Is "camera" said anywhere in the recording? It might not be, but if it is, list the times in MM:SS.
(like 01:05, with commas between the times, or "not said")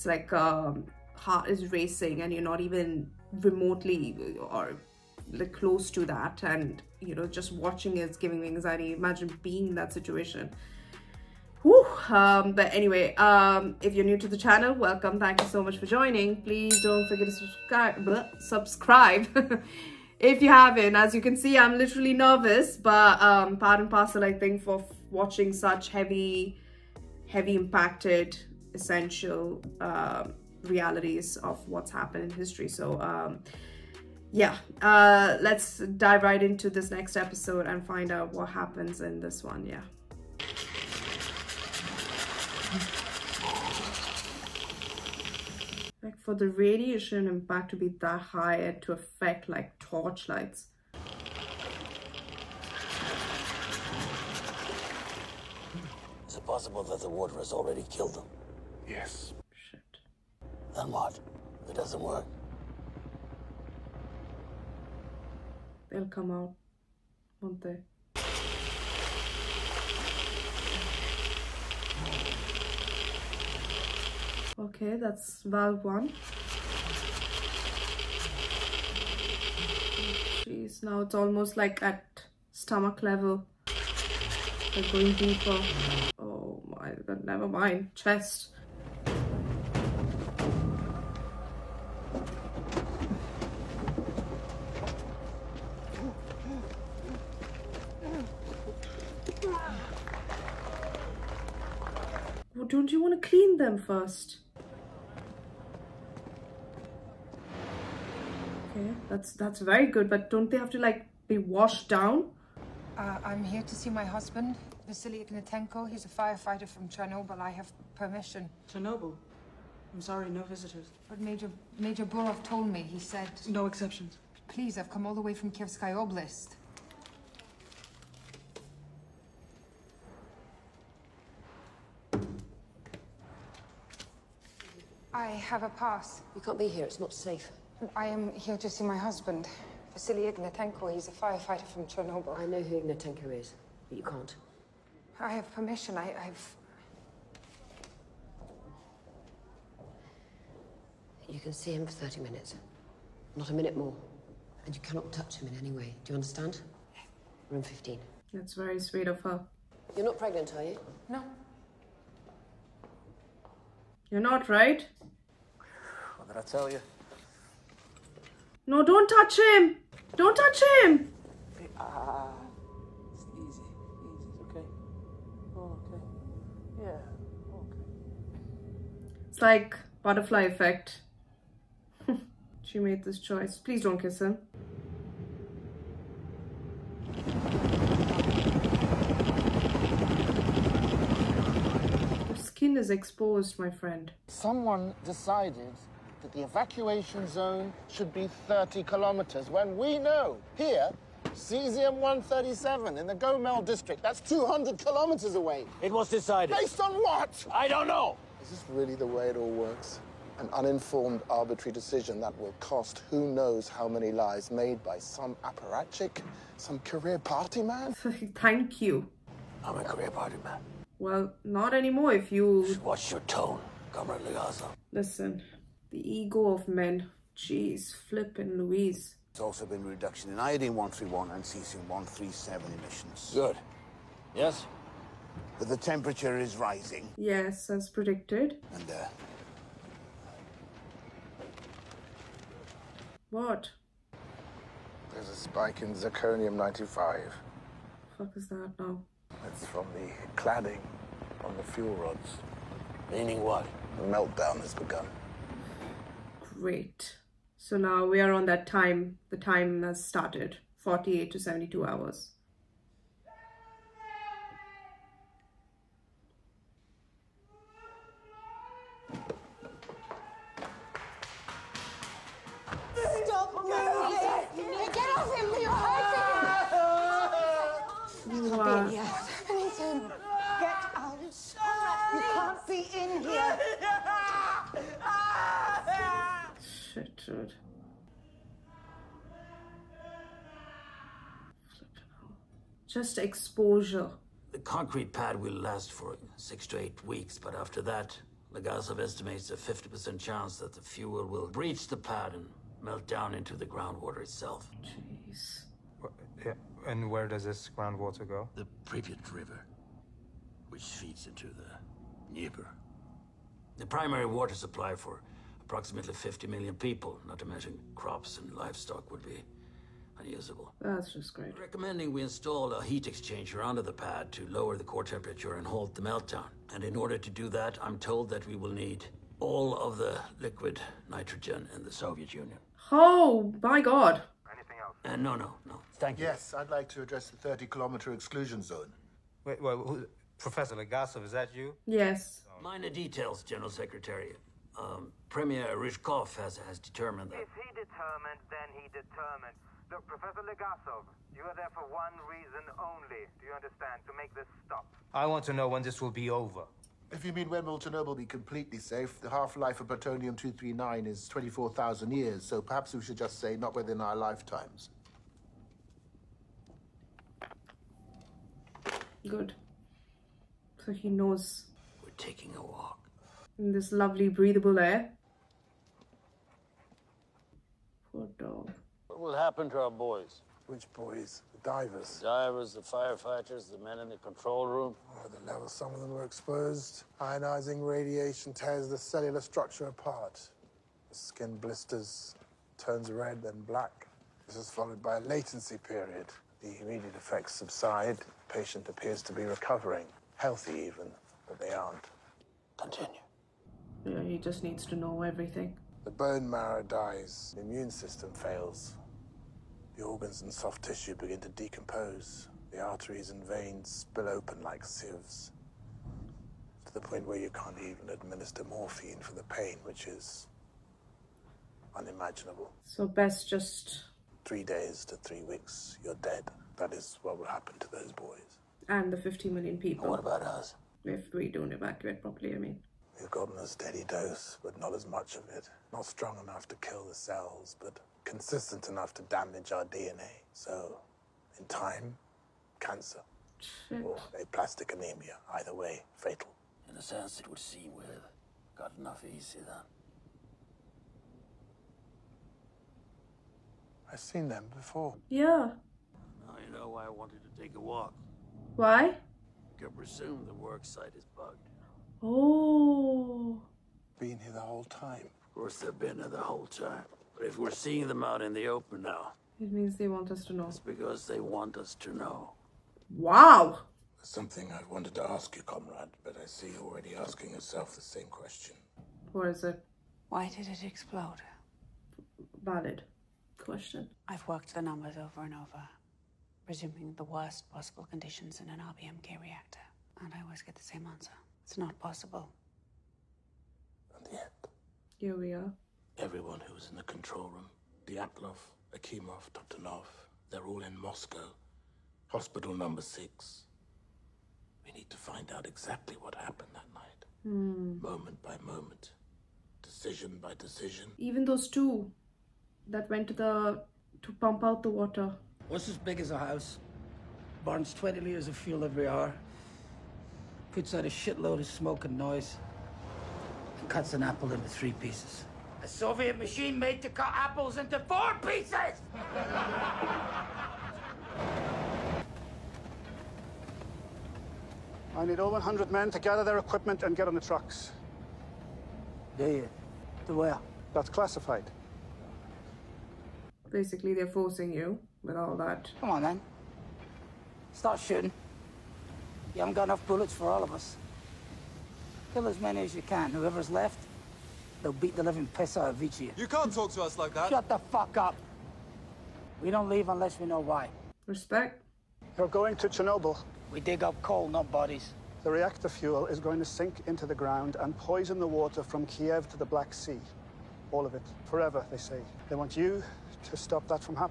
not said.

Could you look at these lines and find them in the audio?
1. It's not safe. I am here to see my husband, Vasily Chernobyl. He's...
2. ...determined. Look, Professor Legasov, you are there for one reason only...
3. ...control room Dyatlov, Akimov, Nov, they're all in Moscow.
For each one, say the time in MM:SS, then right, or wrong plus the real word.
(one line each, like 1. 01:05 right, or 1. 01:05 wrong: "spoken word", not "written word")
1. 02:16 wrong: "Ignatenko", not "Chernobyl"
2. 05:48 right
3. 08:17 right.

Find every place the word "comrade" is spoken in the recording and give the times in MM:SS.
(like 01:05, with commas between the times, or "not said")
03:43, 07:55.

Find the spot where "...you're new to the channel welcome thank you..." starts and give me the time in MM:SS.
00:13.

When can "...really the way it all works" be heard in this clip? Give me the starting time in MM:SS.
03:28.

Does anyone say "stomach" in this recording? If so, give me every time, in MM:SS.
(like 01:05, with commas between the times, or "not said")
01:22.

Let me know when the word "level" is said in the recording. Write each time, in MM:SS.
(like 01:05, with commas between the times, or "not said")
01:23, 06:25.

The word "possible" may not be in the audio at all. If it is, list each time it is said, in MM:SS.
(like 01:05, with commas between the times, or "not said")
00:56, 08:07, 08:11.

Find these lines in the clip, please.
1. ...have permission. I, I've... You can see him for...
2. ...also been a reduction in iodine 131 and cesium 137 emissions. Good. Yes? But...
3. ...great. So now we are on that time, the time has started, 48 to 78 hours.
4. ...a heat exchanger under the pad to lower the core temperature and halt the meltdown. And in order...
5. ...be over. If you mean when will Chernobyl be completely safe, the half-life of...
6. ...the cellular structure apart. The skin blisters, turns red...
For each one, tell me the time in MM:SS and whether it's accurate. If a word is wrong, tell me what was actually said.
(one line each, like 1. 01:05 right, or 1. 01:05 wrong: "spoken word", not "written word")
1. 02:25 right
2. 03:49 right
3. 04:16 wrong: "72", not "78"
4. 05:22 right
5. 05:56 right
6. 06:28 right.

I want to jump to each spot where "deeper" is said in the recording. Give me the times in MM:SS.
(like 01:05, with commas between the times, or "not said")
01:25.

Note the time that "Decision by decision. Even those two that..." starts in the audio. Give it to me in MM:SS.
08:29.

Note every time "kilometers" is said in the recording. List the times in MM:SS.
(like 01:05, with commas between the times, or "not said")
03:18, 03:24, 05:37.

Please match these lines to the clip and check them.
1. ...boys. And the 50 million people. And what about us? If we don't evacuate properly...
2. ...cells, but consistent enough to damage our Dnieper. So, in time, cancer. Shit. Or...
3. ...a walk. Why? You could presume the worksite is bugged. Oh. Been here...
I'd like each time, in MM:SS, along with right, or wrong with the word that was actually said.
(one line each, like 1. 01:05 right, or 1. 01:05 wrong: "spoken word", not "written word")
1. 07:08 right
2. 07:17 wrong: "DNA", not "Dnieper"
3. 07:37 right.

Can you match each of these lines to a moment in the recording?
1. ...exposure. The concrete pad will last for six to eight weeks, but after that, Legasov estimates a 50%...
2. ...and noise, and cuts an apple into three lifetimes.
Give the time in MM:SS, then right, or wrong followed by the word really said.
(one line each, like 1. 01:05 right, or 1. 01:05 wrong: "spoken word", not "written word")
1. 04:53 right
2. 08:42 wrong: "pieces", not "lifetimes".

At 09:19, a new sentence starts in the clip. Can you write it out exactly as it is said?
We don't leave unless we know why.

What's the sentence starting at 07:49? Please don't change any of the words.
It means they want us to know.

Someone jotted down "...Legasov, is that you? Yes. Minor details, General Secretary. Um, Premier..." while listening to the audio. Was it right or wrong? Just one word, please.
right.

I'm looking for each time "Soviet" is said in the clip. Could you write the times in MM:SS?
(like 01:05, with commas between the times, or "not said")
05:31, 08:45.